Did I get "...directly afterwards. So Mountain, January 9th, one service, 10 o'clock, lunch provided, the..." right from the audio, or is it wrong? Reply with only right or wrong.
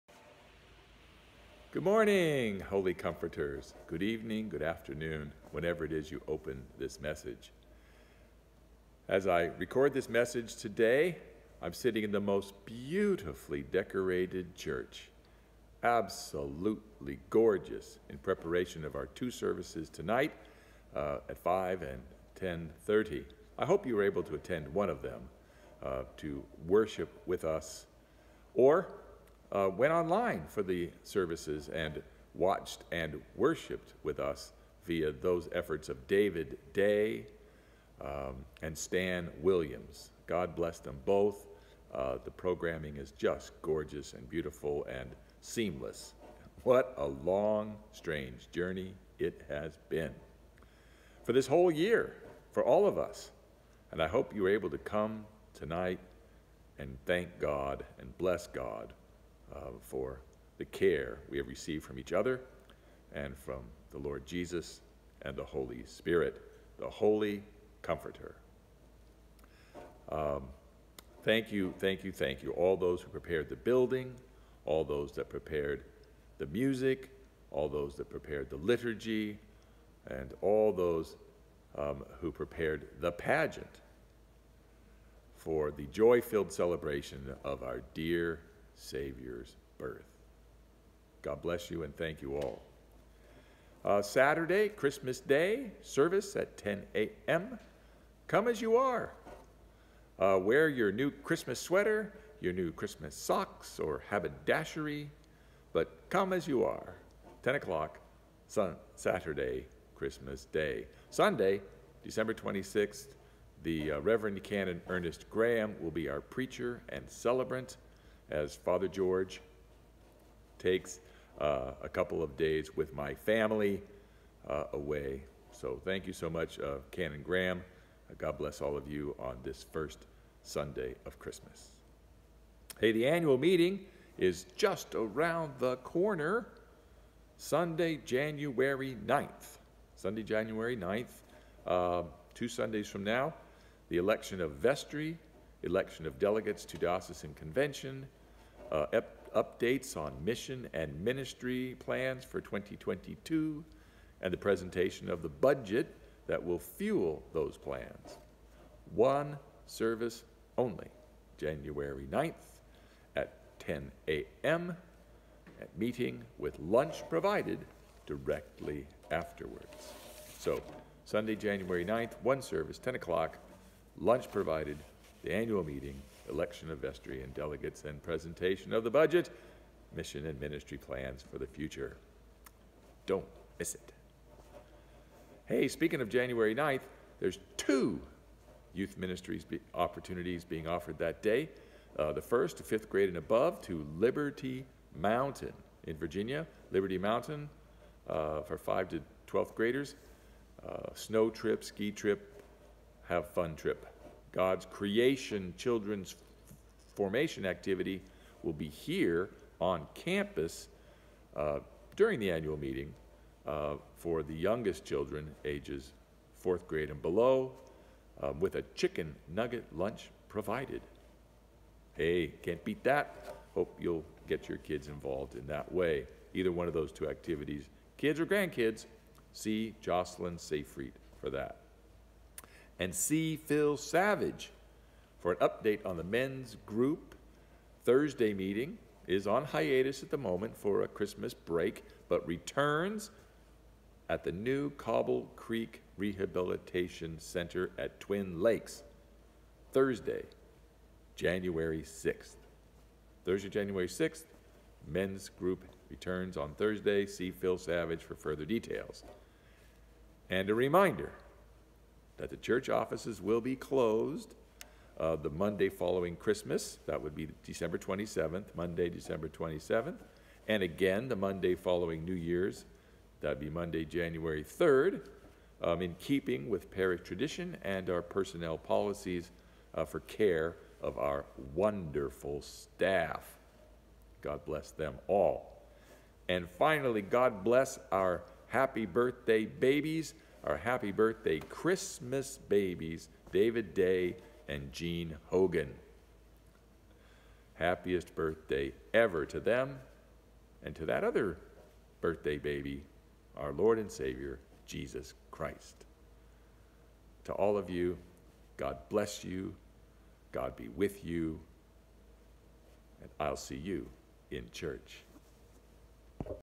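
wrong.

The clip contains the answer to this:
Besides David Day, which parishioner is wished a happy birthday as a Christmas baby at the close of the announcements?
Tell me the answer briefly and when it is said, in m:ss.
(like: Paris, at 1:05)
Jean Hogan, at 4:54.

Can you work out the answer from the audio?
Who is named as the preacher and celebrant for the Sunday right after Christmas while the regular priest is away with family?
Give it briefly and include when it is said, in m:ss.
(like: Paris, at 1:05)
Canon Ernest Graham, at 1:54.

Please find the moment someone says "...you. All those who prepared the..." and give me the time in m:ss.
1:12.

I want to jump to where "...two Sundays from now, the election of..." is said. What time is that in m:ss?
2:22.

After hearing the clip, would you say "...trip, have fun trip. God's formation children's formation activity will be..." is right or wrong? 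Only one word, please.
wrong.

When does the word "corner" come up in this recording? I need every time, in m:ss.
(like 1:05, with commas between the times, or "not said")
2:15.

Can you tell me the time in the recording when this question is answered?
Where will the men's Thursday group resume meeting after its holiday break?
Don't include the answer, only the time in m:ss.
4:04.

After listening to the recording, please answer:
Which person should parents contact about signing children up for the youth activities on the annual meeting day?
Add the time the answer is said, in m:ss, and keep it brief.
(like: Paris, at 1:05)
Jocelyn Seyfried, at 3:49.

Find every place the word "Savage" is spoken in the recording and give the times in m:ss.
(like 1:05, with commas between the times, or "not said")
3:53, 4:17.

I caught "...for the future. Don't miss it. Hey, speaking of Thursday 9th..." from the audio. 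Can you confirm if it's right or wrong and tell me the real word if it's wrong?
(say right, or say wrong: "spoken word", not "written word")
wrong: "January", not "Thursday".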